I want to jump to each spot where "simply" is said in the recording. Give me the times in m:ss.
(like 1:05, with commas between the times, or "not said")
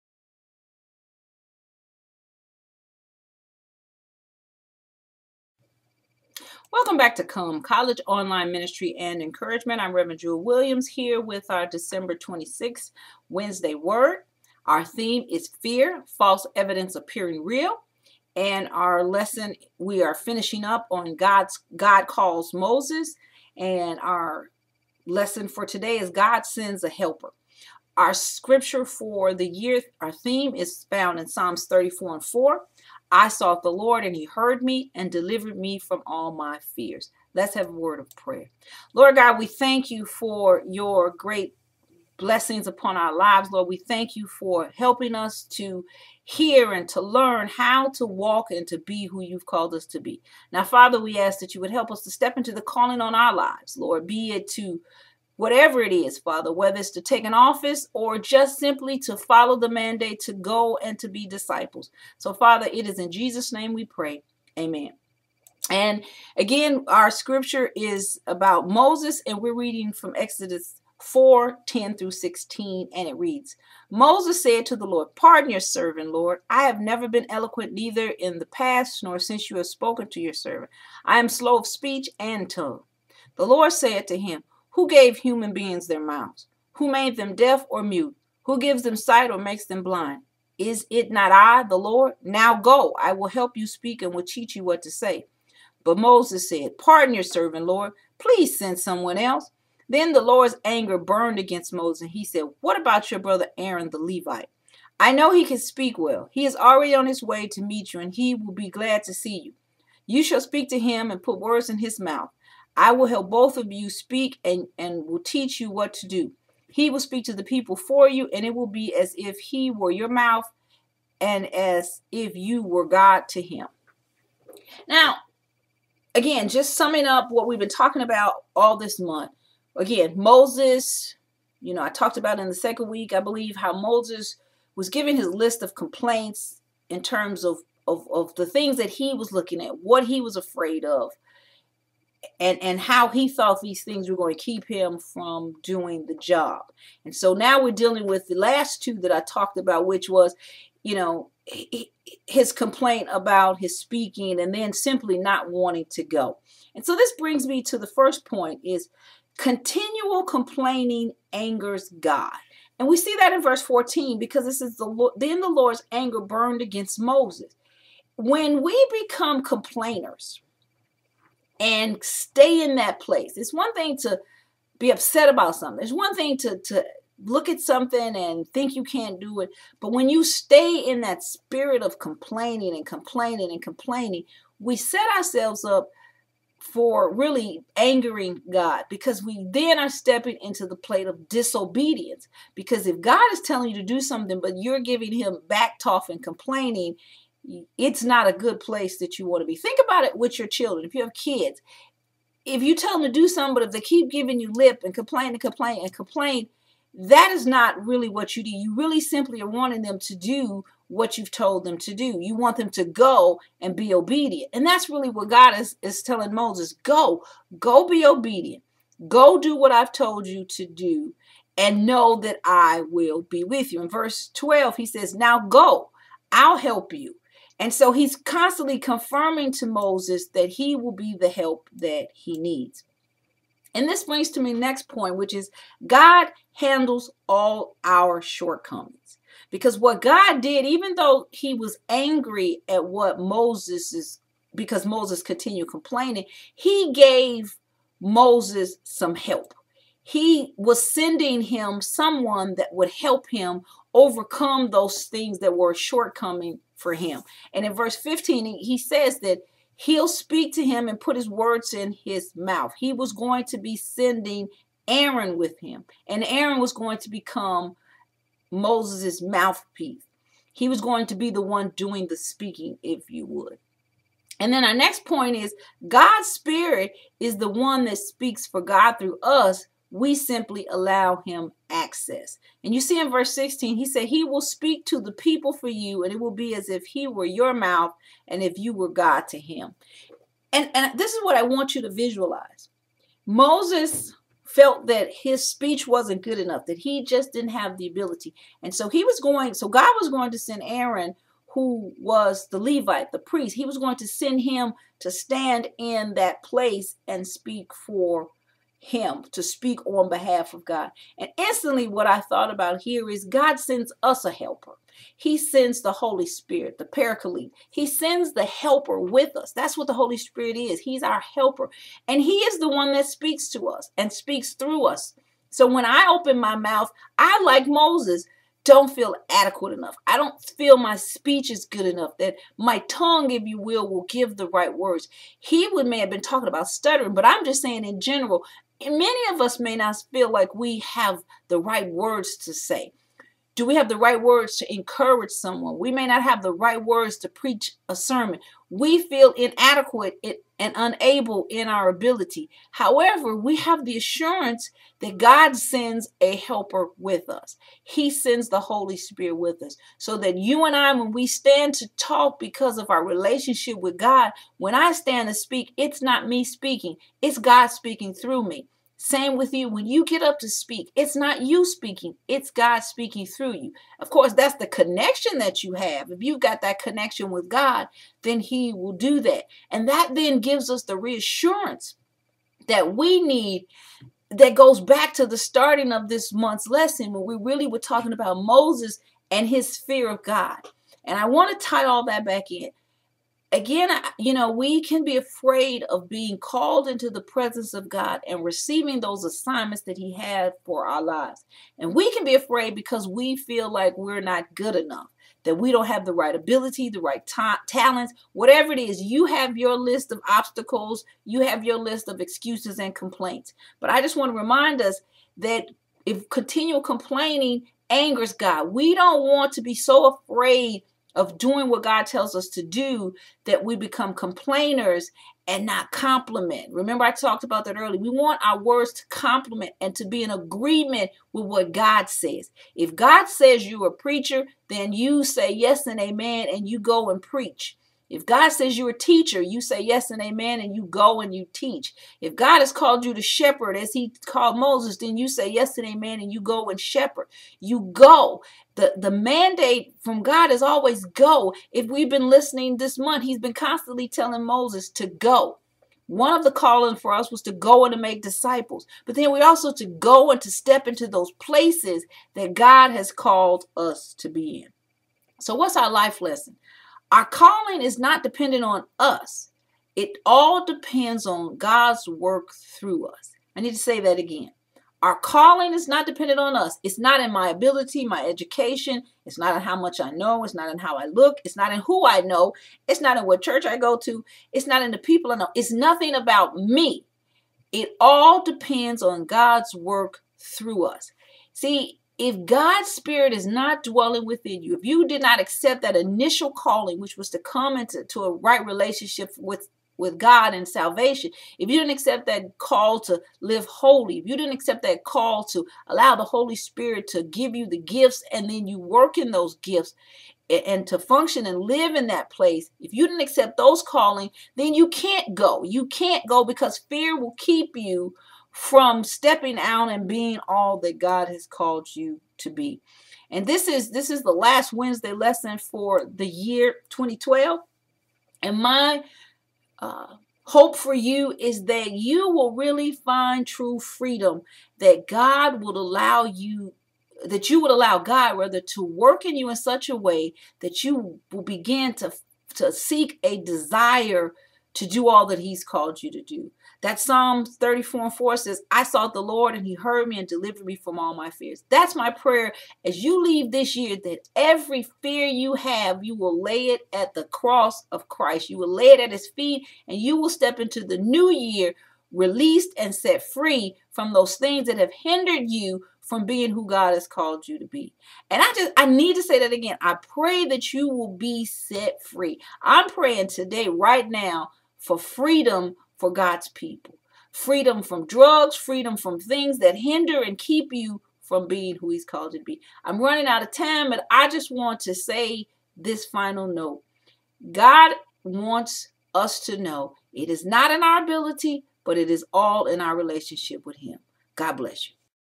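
0:58, 2:34, 3:29, 4:40.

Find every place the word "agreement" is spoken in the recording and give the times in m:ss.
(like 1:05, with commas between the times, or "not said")
7:10.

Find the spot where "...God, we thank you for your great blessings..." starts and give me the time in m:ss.
0:39.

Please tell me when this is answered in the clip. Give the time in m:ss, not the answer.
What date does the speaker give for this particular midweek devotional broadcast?
0:11.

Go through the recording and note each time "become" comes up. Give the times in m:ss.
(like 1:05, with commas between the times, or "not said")
2:49, 4:27, 7:03.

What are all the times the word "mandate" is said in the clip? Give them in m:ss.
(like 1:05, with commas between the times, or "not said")
0:59, 7:29.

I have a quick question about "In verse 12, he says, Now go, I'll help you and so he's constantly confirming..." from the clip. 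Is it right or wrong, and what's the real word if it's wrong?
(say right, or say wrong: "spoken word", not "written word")
right.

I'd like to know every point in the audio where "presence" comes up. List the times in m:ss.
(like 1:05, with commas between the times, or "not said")
6:37.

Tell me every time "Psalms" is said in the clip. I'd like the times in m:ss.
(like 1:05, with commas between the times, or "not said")
0:31, 9:06.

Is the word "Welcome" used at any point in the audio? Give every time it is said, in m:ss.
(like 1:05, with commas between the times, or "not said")
0:06.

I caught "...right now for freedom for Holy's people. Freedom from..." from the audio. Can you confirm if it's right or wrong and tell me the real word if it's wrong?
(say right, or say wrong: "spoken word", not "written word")
wrong: "God", not "Holy".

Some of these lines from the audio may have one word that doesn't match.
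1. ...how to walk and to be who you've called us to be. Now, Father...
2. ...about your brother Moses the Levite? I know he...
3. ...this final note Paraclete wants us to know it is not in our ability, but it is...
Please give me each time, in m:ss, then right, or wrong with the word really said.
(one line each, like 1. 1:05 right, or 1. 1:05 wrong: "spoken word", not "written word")
1. 0:47 right
2. 1:42 wrong: "Aaron", not "Moses"
3. 9:45 wrong: "God", not "Paraclete".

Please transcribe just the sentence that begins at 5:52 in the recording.
However, we have the assurance that God sends a helper with us.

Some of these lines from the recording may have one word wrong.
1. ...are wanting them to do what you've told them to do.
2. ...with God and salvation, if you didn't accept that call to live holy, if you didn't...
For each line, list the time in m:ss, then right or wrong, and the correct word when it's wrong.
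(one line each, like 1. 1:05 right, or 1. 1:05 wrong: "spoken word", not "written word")
1. 3:29 right
2. 8:19 right.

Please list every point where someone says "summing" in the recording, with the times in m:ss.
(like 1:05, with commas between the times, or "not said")
2:06.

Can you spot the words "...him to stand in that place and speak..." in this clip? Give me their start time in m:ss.
5:04.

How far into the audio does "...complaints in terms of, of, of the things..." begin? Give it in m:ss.
2:15.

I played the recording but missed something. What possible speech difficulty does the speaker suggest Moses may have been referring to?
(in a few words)
Stuttering.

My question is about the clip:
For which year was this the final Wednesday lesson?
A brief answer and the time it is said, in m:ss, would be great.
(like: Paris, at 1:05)
2012, at 8:46.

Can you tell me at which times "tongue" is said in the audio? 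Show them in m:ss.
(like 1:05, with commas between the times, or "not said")
1:22, 5:32.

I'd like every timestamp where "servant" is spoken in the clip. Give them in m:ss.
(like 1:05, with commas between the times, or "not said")
1:15, 1:20, 1:37.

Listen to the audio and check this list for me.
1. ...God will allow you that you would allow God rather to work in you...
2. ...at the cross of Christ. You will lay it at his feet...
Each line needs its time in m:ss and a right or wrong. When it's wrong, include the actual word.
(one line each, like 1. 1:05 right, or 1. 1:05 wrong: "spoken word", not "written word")
1. 8:55 right
2. 9:16 right.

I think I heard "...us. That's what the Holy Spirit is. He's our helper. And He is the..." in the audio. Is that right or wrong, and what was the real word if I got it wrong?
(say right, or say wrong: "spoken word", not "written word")
right.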